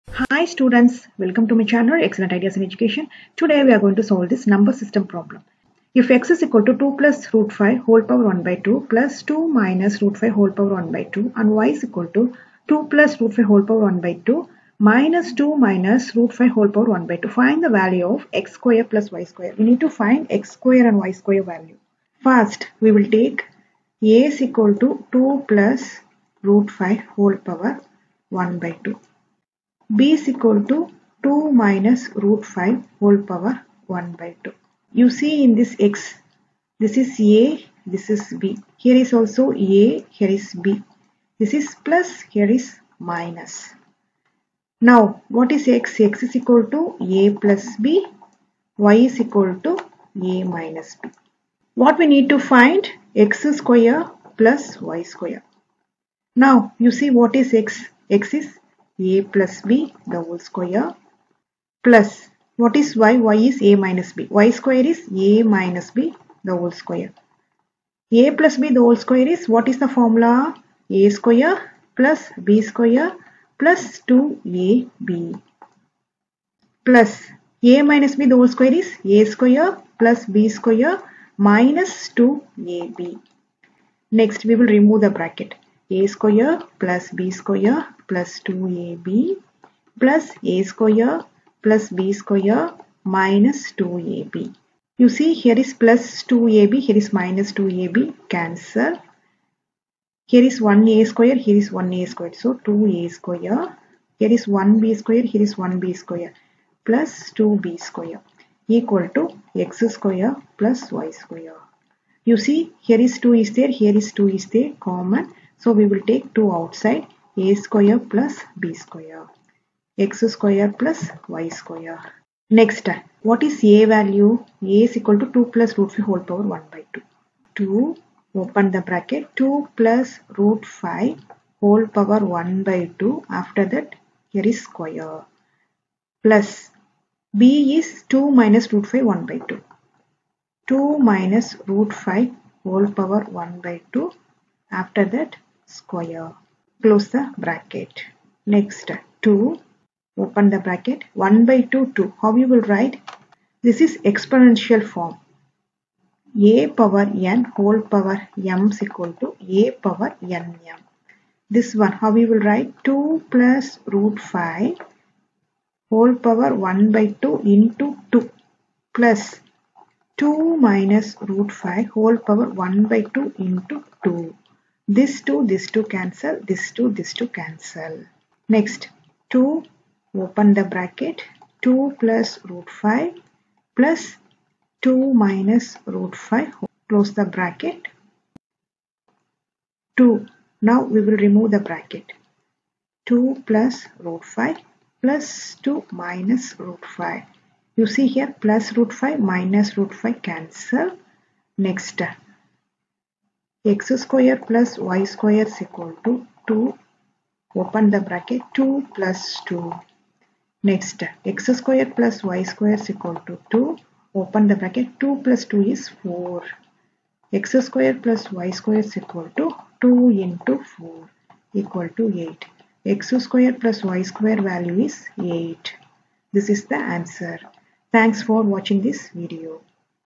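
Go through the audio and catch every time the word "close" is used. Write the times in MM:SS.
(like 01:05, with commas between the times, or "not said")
02:26, 03:06.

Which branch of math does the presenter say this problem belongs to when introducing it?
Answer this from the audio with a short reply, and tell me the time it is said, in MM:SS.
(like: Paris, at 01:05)
number system, at 00:04.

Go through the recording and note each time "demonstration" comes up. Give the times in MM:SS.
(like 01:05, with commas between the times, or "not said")
not said.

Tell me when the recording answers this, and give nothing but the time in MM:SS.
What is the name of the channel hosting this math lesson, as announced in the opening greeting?
00:02.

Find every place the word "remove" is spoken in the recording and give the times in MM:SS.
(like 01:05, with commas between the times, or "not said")
01:24, 03:11.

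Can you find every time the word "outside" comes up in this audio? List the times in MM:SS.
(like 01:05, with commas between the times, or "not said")
01:56.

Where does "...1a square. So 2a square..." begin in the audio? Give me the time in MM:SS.
01:41.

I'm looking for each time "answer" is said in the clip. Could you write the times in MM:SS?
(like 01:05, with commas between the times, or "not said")
03:46.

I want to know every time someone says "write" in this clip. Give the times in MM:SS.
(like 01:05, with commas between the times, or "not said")
02:32, 02:42.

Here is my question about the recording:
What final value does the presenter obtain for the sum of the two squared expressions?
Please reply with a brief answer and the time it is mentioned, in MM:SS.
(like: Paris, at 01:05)
8, at 03:42.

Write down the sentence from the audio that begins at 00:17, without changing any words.
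Find the value of x square plus y square.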